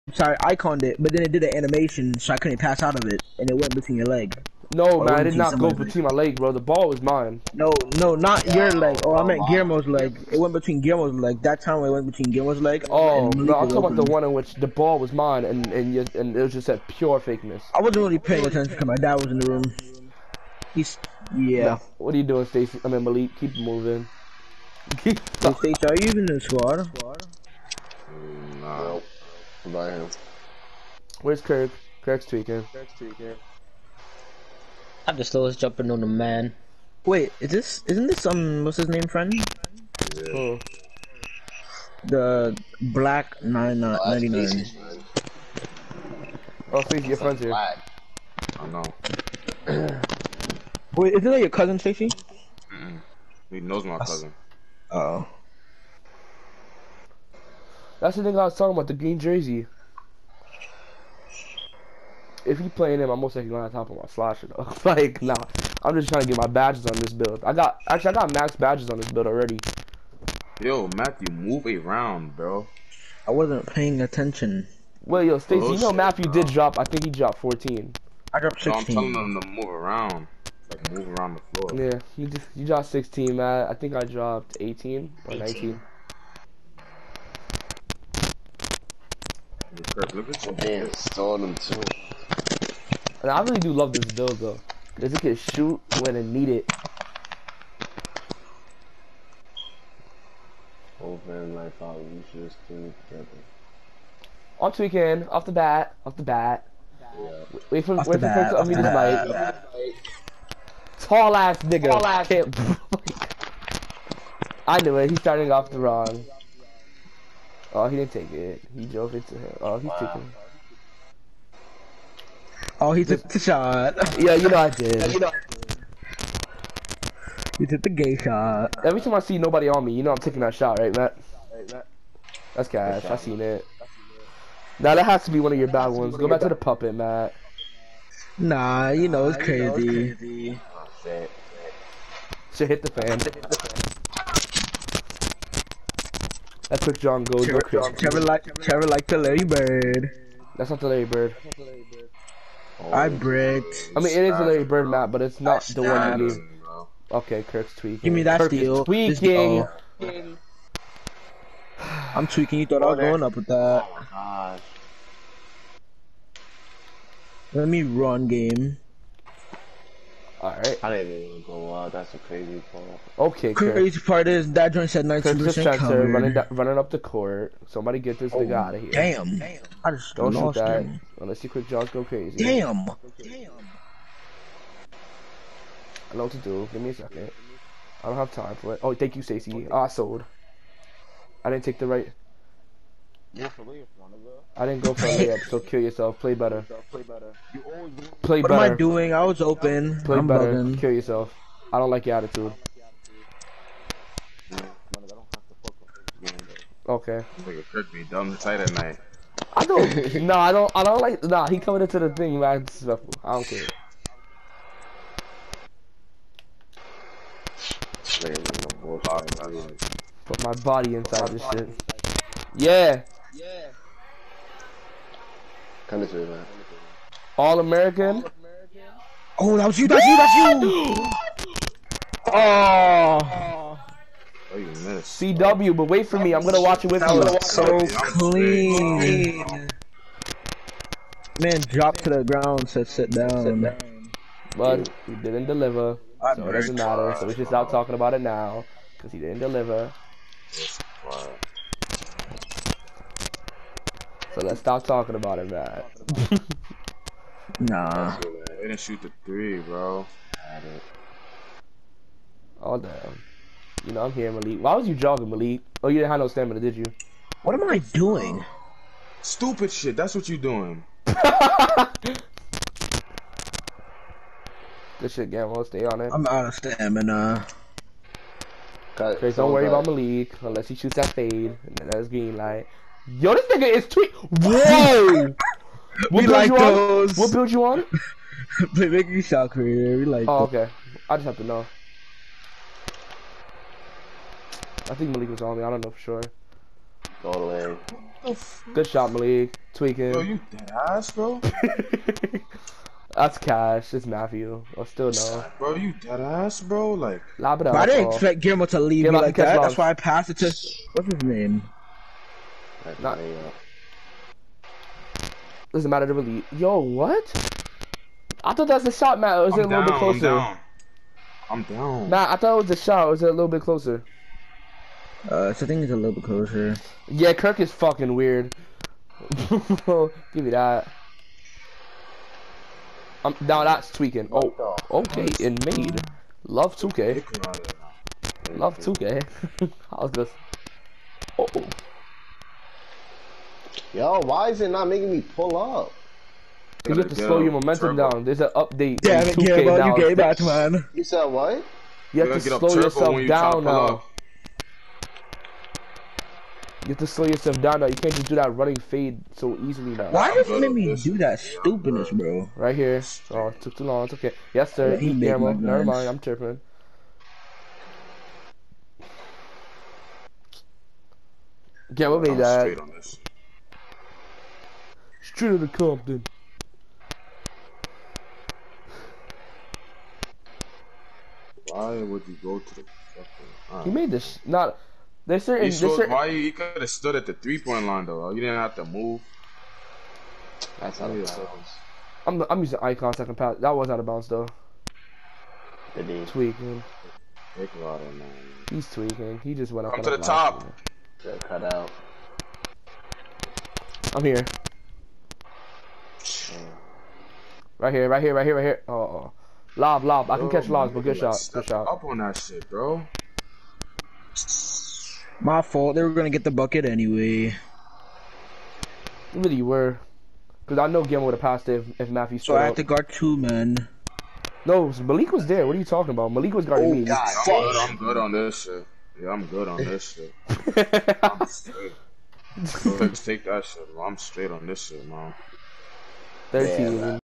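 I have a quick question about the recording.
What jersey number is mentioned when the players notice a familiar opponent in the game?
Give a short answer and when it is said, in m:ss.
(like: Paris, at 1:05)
99, at 0:44.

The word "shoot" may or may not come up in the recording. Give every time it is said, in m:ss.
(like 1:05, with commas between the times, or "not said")
1:35, 3:00, 4:18, 4:40.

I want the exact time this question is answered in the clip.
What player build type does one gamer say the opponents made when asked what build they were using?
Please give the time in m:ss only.
4:49.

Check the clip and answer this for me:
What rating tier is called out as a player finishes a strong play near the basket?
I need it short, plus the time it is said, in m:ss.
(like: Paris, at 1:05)
All American, at 3:47.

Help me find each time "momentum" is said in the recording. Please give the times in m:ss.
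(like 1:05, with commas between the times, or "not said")
5:47.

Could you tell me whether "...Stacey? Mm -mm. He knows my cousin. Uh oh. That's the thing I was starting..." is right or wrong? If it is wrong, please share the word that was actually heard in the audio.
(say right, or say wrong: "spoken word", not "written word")
wrong: "talking", not "starting".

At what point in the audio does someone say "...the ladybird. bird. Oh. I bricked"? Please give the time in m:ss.
2:30.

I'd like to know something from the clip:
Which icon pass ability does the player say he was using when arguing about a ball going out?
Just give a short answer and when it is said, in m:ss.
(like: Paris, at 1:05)
icon second pass, at 6:32.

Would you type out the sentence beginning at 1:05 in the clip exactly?
I'm just trying to get my badges on this build.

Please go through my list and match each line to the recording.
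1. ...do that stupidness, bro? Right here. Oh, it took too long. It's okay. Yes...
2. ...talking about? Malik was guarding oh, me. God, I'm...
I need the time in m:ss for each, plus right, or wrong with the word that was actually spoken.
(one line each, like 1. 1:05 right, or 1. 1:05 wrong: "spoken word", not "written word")
1. 6:00 right
2. 7:05 right.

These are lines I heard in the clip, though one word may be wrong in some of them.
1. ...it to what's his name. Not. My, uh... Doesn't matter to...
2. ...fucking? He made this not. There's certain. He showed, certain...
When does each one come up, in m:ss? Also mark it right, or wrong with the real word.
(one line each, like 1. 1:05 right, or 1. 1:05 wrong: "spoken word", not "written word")
1. 5:10 right
2. 6:23 right.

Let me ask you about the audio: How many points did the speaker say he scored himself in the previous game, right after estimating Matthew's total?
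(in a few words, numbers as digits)
16.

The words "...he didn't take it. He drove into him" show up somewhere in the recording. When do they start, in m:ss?
1:57.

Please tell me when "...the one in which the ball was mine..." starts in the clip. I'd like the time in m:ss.
0:13.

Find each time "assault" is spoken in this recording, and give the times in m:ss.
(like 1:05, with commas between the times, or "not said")
not said.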